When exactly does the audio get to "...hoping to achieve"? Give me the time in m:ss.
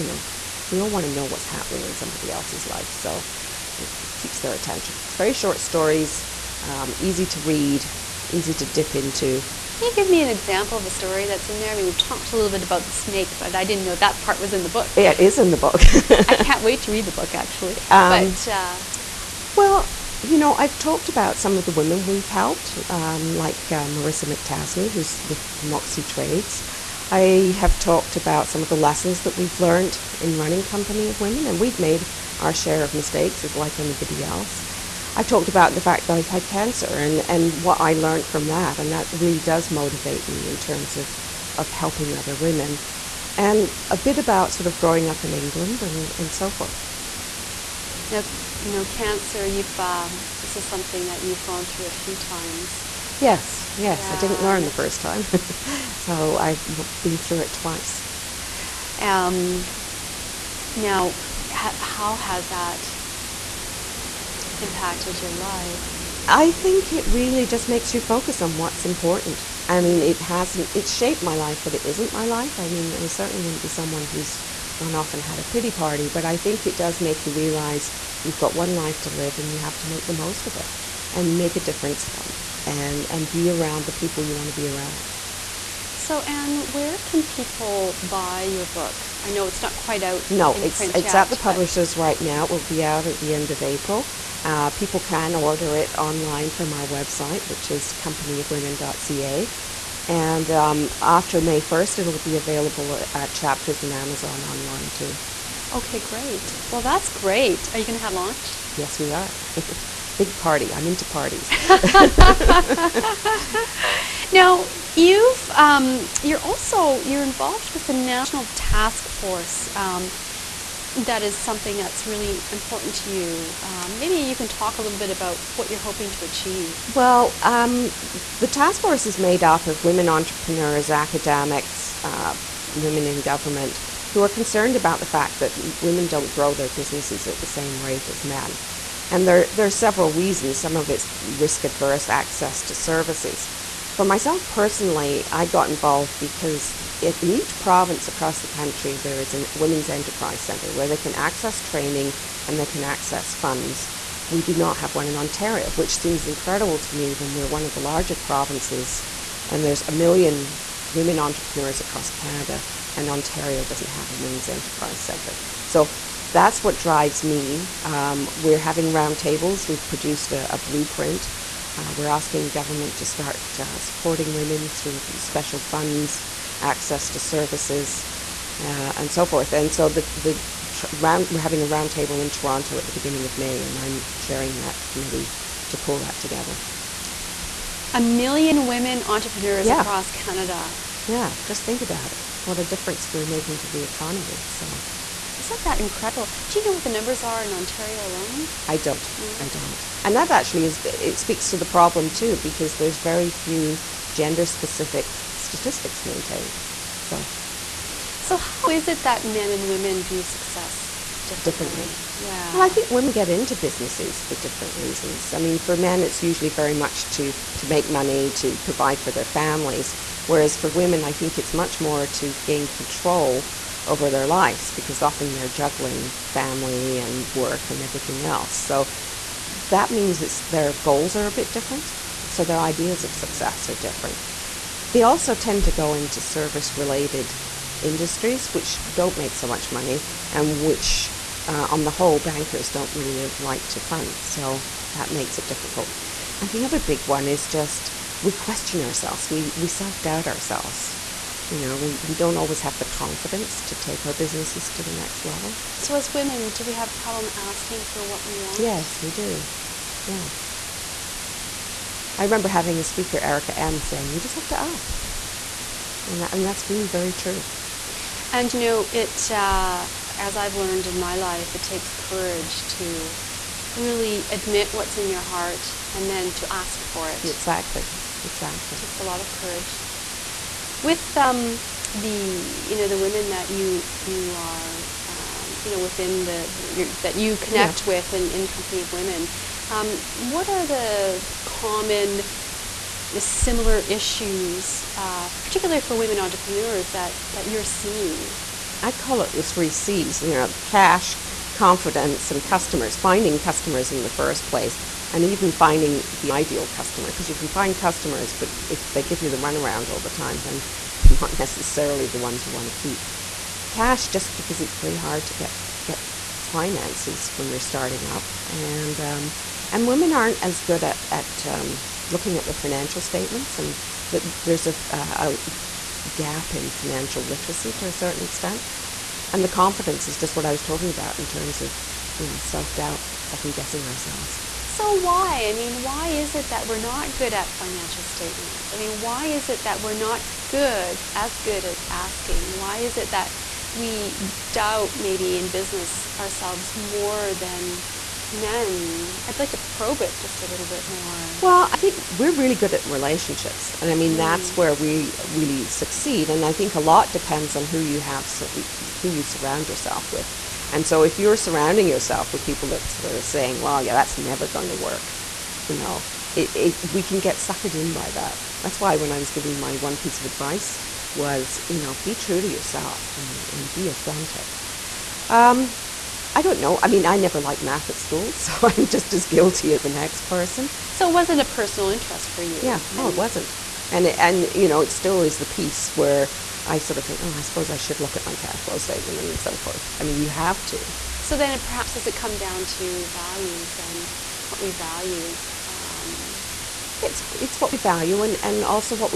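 2:05.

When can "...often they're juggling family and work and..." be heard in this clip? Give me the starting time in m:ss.
3:45.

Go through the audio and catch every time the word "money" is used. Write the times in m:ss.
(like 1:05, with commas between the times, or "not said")
3:37, 3:59.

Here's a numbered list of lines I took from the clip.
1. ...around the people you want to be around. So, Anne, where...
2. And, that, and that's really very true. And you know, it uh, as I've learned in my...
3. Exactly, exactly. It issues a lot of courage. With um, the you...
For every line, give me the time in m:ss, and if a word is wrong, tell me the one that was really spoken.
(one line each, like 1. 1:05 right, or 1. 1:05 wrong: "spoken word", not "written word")
1. 1:23 right
2. 4:26 right
3. 4:37 wrong: "takes", not "issues".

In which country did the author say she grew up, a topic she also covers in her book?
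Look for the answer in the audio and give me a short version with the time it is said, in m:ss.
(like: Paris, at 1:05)
England, at 0:45.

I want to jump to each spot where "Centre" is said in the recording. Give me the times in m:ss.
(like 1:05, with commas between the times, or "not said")
2:30, 2:45.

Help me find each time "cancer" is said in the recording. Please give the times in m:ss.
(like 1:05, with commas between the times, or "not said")
0:36, 0:48.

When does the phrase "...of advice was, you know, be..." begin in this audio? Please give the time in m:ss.
6:10.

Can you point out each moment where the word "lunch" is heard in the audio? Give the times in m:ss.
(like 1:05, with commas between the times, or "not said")
1:48.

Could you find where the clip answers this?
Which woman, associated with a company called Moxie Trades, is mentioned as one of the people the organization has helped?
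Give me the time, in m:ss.
0:23.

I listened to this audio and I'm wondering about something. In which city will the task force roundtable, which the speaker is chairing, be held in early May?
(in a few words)
Toronto.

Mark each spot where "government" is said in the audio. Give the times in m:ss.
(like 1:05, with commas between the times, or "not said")
2:13, 2:52.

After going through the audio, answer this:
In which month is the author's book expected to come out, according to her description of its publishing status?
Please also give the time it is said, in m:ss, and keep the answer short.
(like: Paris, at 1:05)
April, at 1:33.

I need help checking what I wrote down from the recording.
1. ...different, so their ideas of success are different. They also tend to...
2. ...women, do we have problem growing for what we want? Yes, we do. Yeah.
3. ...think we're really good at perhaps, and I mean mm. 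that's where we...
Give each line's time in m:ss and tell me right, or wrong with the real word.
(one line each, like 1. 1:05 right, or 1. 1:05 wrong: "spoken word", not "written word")
1. 3:51 right
2. 4:16 wrong: "asking", not "growing"
3. 5:51 wrong: "relationships", not "perhaps".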